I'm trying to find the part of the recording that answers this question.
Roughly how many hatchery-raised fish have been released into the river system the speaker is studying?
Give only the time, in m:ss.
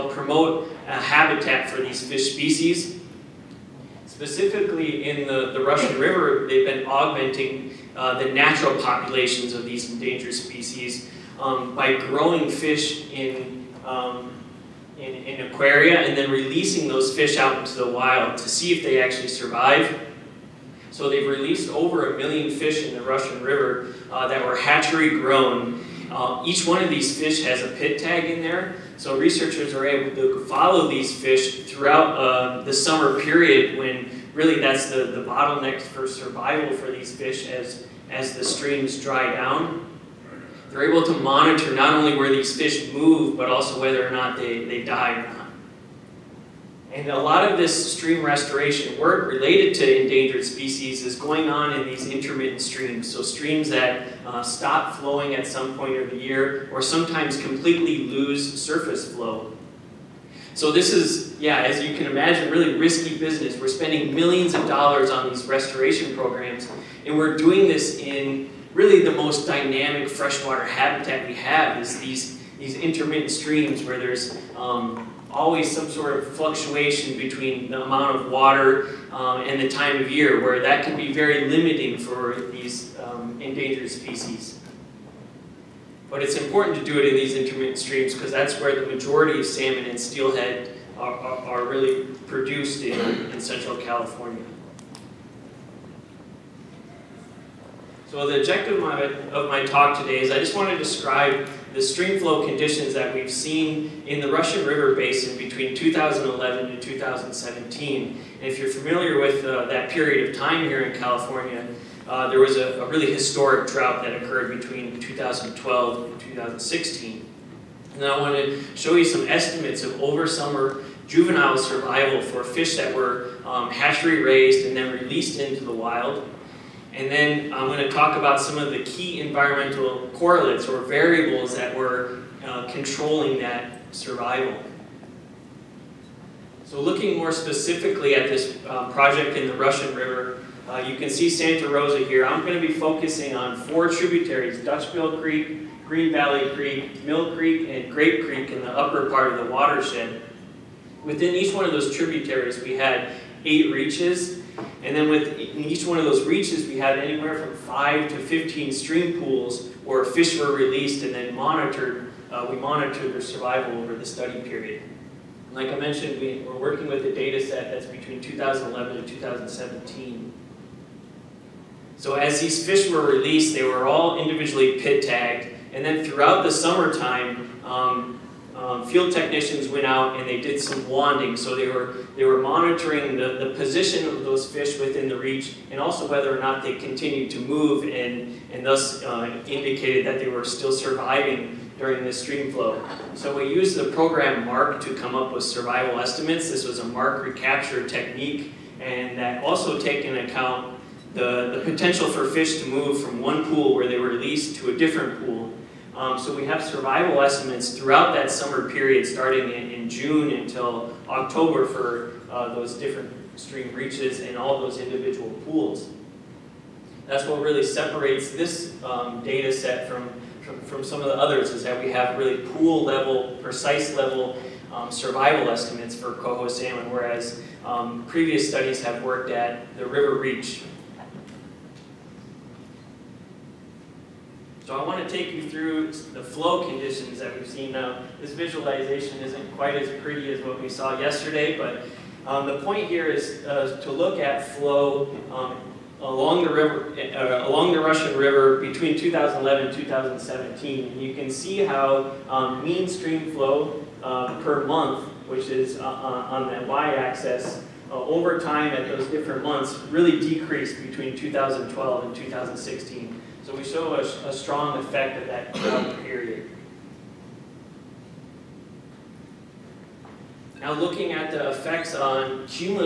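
0:21.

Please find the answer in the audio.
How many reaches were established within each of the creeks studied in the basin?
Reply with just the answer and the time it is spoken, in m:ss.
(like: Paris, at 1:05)
8, at 2:33.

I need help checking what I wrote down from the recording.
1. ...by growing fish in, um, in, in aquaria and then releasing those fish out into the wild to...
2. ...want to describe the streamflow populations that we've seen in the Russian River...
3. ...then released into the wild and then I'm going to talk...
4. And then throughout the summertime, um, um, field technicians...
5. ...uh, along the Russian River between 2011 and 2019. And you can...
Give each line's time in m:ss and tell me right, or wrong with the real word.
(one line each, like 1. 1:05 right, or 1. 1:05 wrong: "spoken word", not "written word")
1. 0:11 right
2. 1:40 wrong: "conditions", not "populations"
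3. 2:04 right
4. 2:55 right
5. 4:07 wrong: "2017", not "2019".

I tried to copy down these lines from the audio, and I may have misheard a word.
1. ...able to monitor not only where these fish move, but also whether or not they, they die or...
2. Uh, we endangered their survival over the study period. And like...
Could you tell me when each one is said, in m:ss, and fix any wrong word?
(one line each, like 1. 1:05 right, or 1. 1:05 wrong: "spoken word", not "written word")
1. 0:40 right
2. 2:42 wrong: "monitored", not "endangered".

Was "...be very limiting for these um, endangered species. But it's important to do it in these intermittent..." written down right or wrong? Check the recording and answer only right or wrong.
right.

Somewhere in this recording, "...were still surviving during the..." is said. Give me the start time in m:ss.
3:10.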